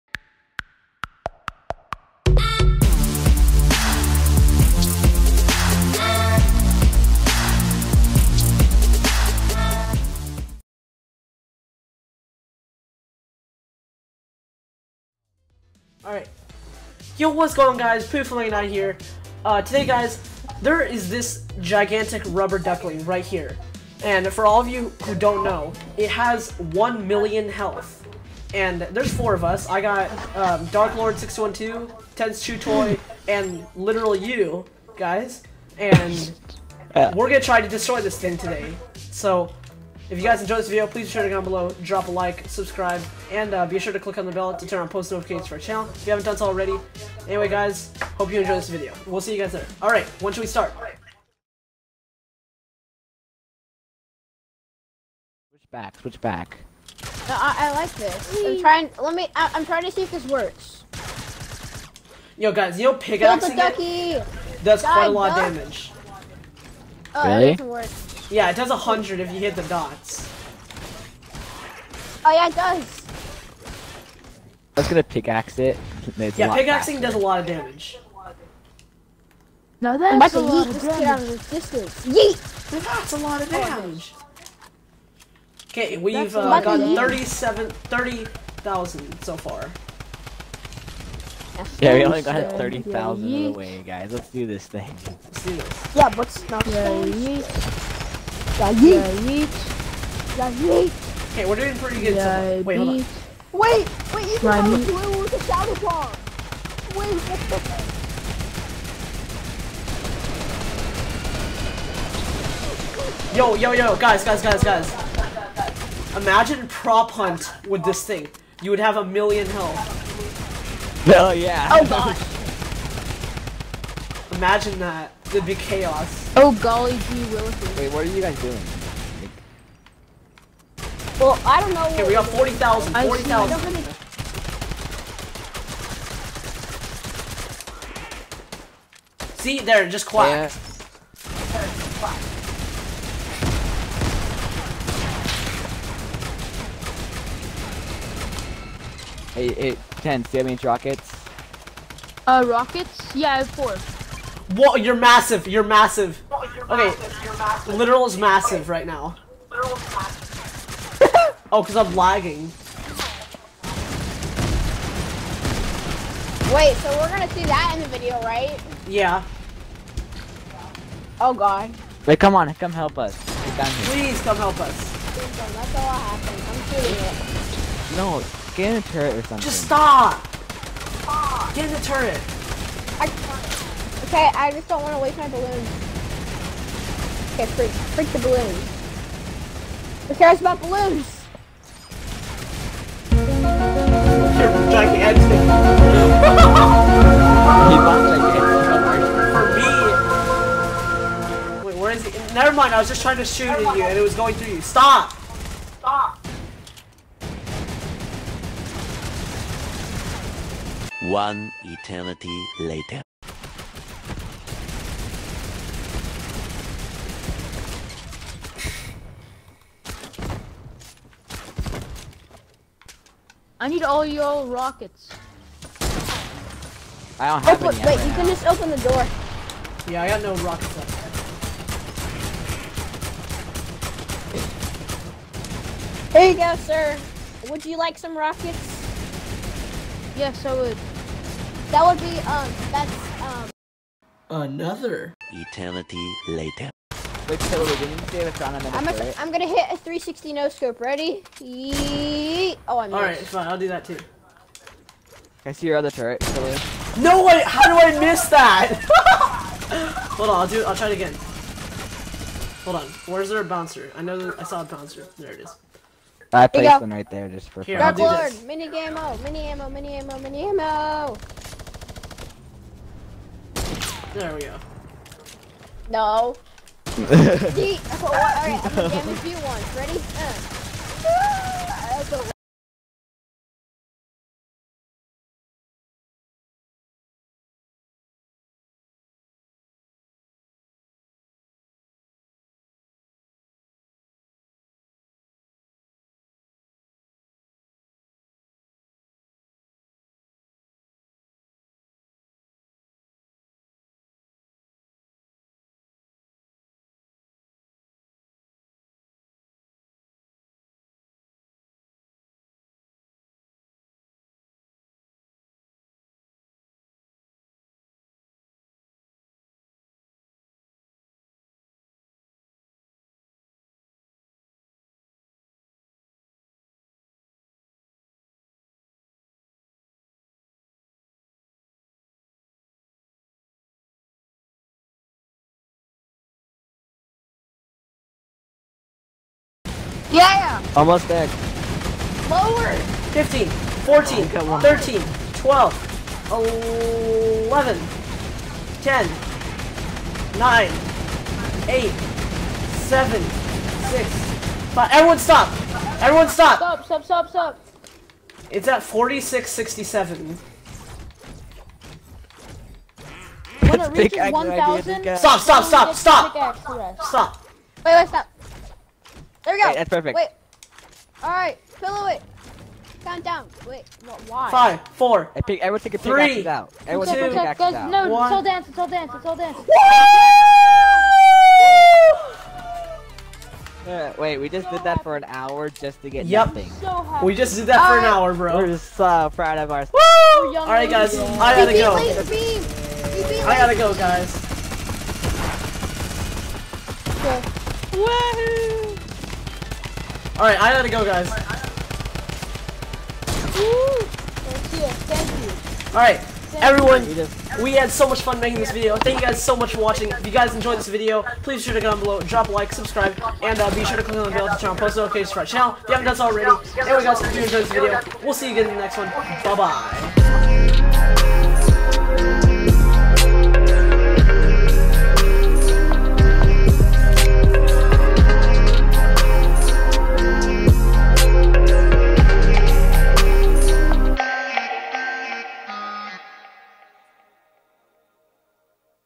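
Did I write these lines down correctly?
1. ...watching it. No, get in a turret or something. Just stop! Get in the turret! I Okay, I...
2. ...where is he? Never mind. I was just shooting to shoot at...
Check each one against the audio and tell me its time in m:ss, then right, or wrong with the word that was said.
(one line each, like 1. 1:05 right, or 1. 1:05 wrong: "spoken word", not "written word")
1. 2:56 wrong: "shooting", not "watching"
2. 3:21 wrong: "trying", not "shooting".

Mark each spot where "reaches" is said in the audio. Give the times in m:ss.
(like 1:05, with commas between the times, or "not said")
6:03.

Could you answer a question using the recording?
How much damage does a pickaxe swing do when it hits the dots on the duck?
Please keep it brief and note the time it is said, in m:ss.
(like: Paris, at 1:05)
100, at 1:08.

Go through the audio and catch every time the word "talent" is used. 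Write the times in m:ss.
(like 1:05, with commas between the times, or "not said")
not said.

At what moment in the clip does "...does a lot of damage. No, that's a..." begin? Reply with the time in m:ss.
1:17.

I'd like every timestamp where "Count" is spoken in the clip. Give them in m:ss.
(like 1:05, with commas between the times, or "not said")
6:13.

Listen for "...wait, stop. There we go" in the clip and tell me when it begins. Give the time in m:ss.
6:07.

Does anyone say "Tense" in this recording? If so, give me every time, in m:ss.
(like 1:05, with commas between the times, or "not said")
0:32.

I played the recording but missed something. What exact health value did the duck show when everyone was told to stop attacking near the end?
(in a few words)
4667.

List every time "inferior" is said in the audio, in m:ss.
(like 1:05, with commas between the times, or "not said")
not said.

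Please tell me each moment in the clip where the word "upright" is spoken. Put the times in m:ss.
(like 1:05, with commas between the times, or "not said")
not said.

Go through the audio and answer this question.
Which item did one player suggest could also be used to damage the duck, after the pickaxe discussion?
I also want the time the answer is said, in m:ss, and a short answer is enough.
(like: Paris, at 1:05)
shadow bomb, at 1:45.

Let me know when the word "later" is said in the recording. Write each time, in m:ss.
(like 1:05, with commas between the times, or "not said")
3:32, 4:06.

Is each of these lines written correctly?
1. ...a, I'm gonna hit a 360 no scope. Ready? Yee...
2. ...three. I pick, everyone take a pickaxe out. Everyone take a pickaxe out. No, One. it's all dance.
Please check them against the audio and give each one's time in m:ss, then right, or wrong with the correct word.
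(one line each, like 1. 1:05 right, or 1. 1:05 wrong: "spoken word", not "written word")
1. 4:08 right
2. 6:14 wrong: "four", not "three".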